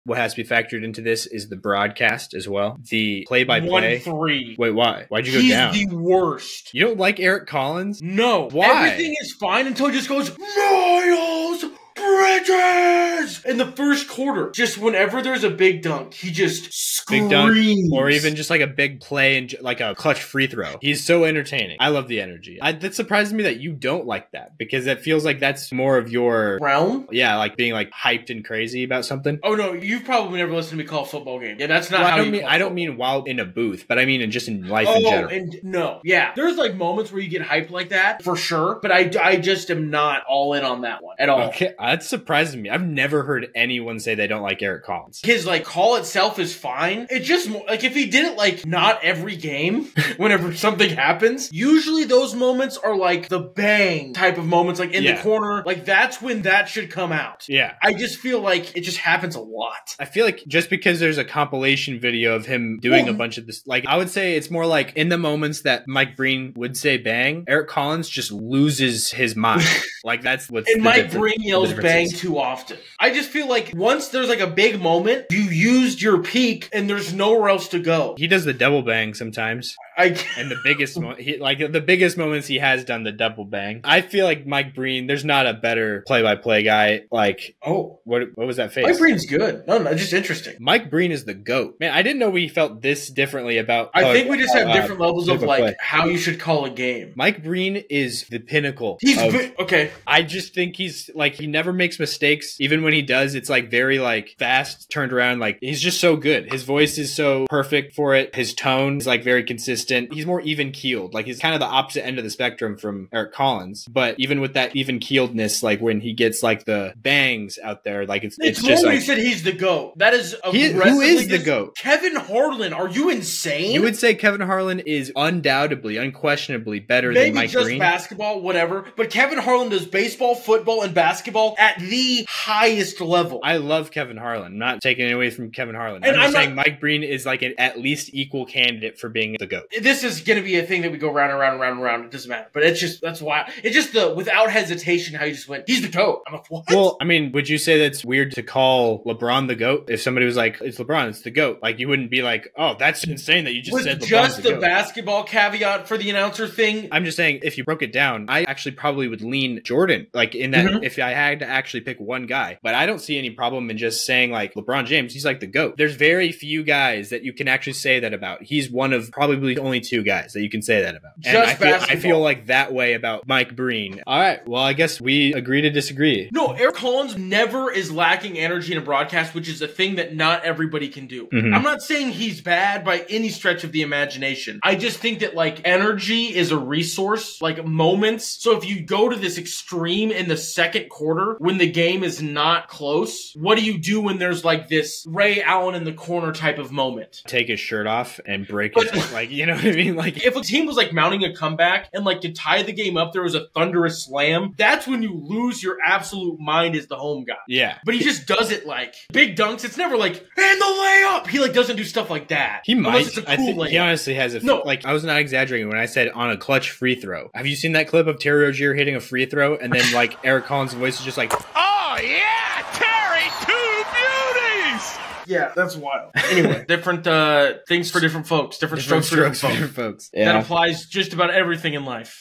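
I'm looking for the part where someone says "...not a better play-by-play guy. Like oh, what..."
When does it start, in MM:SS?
01:25.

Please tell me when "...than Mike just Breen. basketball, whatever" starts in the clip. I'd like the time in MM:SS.
02:07.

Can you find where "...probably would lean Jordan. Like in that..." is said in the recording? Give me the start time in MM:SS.
02:38.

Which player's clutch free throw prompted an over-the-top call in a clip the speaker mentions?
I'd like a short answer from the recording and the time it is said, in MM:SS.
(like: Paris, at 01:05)
Terry Rozier, at 03:38.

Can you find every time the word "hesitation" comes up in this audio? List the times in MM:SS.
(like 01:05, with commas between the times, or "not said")
02:24.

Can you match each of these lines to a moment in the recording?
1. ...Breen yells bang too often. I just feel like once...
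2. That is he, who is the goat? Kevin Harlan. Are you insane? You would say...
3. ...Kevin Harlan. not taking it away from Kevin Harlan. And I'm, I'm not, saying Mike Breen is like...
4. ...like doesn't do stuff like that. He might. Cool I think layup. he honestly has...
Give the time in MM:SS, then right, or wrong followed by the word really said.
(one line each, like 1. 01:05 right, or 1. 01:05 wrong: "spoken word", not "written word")
1. 01:11 right
2. 01:59 right
3. 02:13 right
4. 03:31 right.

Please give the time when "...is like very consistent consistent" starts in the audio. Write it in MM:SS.
01:48.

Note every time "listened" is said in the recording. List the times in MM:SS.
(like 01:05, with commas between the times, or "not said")
00:30.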